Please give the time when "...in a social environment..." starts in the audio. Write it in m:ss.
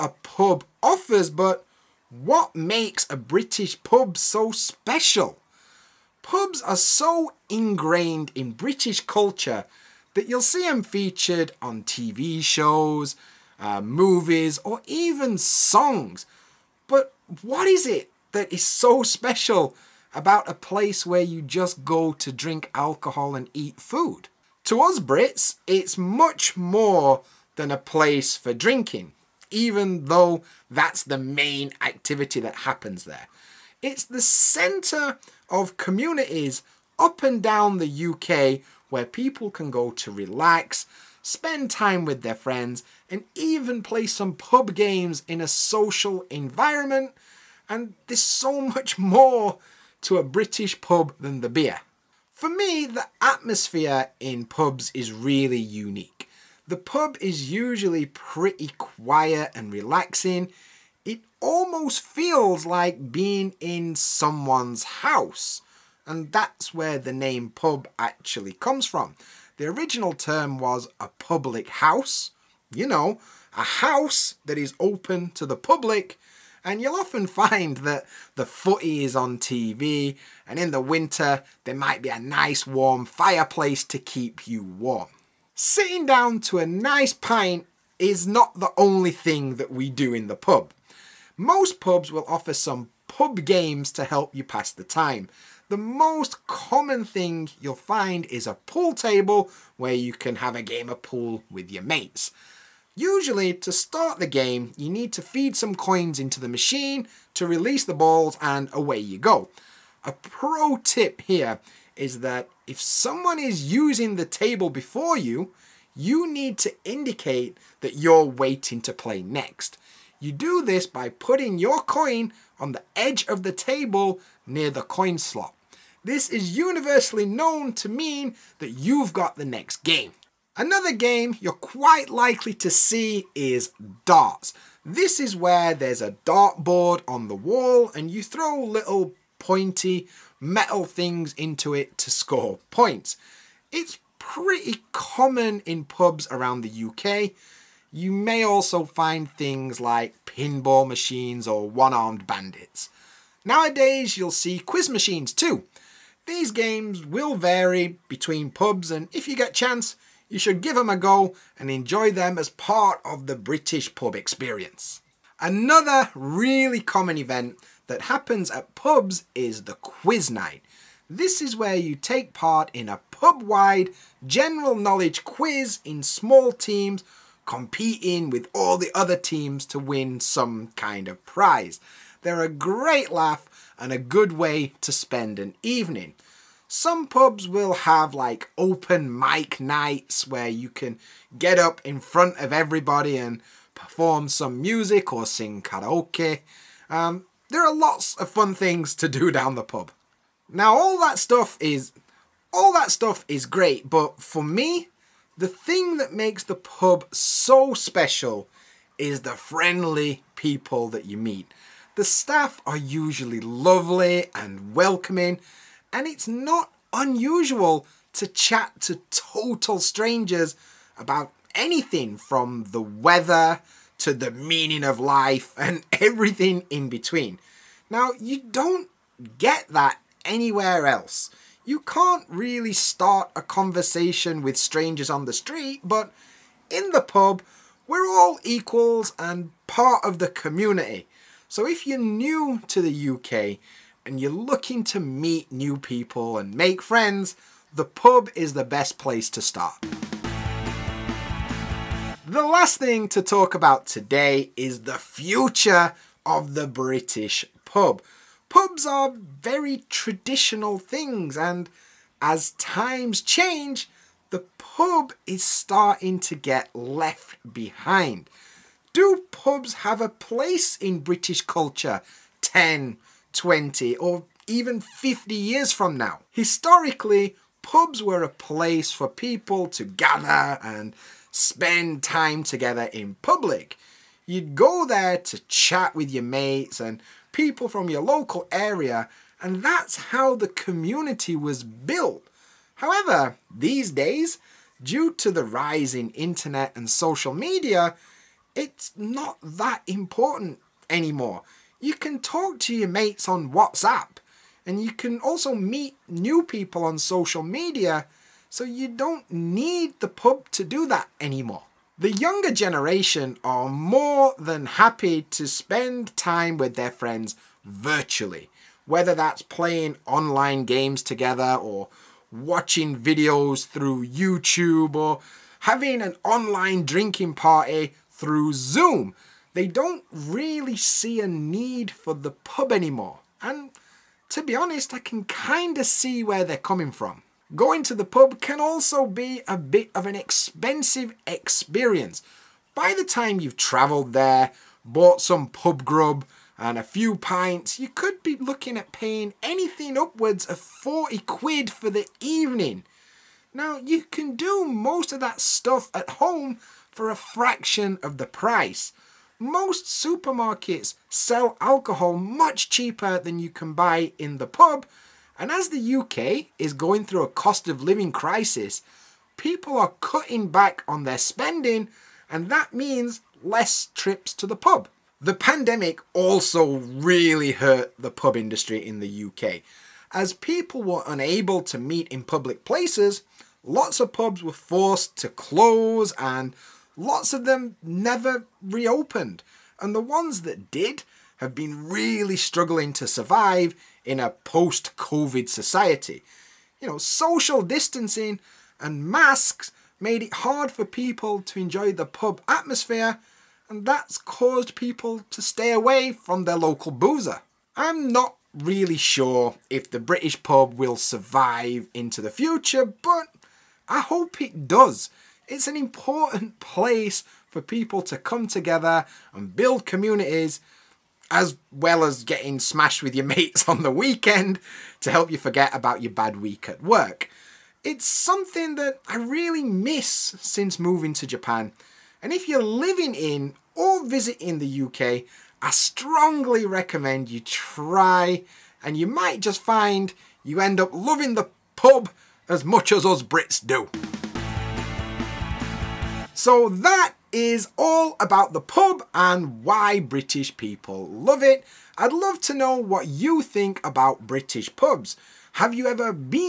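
0:45.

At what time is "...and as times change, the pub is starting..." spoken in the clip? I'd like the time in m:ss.
4:21.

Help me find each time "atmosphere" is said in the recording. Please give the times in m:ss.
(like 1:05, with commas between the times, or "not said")
0:53, 6:42.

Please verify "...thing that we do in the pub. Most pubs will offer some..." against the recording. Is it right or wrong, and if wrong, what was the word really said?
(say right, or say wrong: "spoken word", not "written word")
right.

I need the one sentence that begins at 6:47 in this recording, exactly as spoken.
I'm not really sure if the British pub will survive into the future, but I hope it does.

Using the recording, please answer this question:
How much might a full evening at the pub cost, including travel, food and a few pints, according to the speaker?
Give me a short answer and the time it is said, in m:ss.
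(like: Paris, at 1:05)
upwards of 40 quid, at 5:49.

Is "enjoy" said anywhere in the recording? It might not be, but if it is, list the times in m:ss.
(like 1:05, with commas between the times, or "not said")
2:41, 6:41.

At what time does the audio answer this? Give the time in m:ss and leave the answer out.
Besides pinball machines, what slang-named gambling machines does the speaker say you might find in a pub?
2:31.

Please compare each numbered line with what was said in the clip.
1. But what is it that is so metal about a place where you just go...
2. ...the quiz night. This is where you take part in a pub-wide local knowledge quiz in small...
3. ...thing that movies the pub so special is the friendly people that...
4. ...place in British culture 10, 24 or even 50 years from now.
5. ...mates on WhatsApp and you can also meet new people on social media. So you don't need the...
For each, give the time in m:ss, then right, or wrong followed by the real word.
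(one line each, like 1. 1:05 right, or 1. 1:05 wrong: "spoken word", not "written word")
1. 0:16 wrong: "special", not "metal"
2. 2:49 wrong: "general", not "local"
3. 3:25 wrong: "makes", not "movies"
4. 4:30 wrong: "20", not "24"
5. 5:02 right.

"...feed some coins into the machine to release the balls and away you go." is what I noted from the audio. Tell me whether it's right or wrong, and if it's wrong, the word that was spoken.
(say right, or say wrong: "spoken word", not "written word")
right.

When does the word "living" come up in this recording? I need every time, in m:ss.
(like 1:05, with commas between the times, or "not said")
6:07, 7:12.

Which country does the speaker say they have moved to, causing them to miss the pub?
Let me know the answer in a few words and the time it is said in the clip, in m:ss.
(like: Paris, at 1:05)
Japan, at 7:11.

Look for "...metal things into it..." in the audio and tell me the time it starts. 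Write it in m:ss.
2:20.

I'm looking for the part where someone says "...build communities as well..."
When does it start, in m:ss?
6:59.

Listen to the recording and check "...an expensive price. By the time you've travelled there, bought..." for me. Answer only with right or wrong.
wrong.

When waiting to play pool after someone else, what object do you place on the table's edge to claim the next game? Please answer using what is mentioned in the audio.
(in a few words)
your coin.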